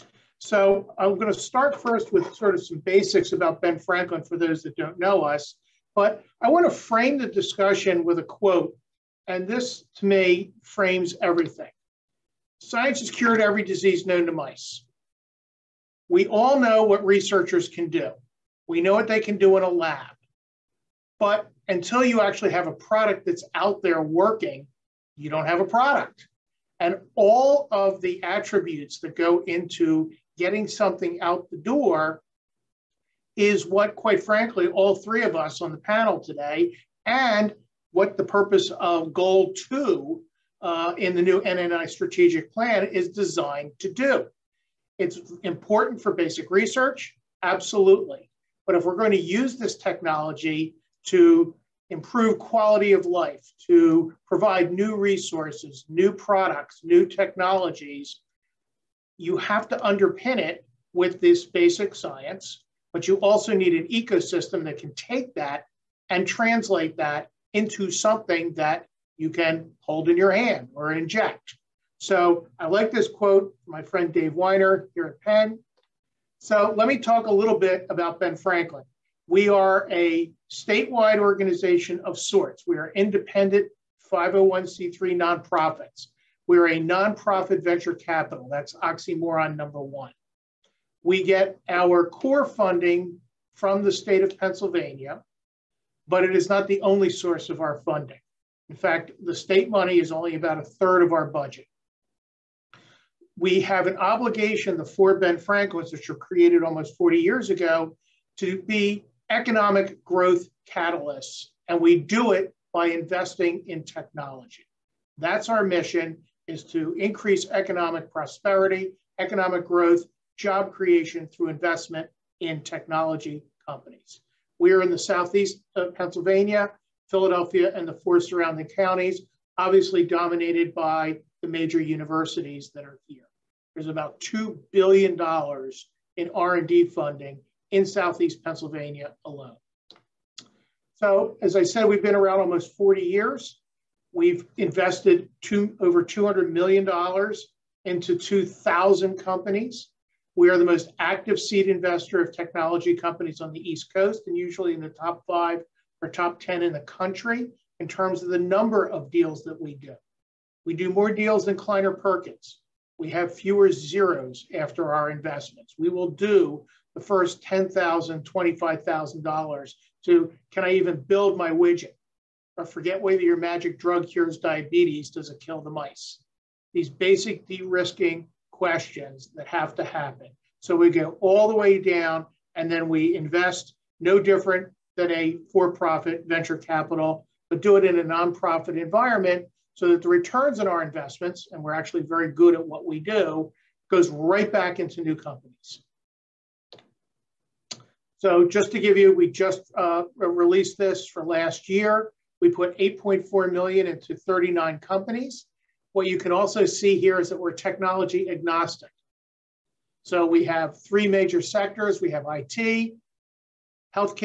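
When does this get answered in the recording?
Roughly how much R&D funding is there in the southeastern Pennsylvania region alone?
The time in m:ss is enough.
2:14.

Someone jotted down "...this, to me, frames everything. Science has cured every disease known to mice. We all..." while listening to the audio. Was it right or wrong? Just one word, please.
right.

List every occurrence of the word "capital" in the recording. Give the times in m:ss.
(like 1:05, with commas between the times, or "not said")
1:27, 3:06.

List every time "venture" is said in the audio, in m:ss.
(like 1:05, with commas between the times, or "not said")
1:27, 3:06.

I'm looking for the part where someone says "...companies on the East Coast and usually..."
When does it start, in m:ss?
2:32.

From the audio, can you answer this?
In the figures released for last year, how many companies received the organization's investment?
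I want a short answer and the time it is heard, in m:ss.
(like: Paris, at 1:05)
39, at 3:24.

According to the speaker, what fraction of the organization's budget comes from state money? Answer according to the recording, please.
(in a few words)
a third.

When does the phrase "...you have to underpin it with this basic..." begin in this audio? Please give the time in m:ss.
0:59.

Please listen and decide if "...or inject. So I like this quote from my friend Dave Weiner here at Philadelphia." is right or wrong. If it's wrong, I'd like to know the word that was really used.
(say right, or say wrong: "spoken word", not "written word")
wrong: "Penn", not "Philadelphia".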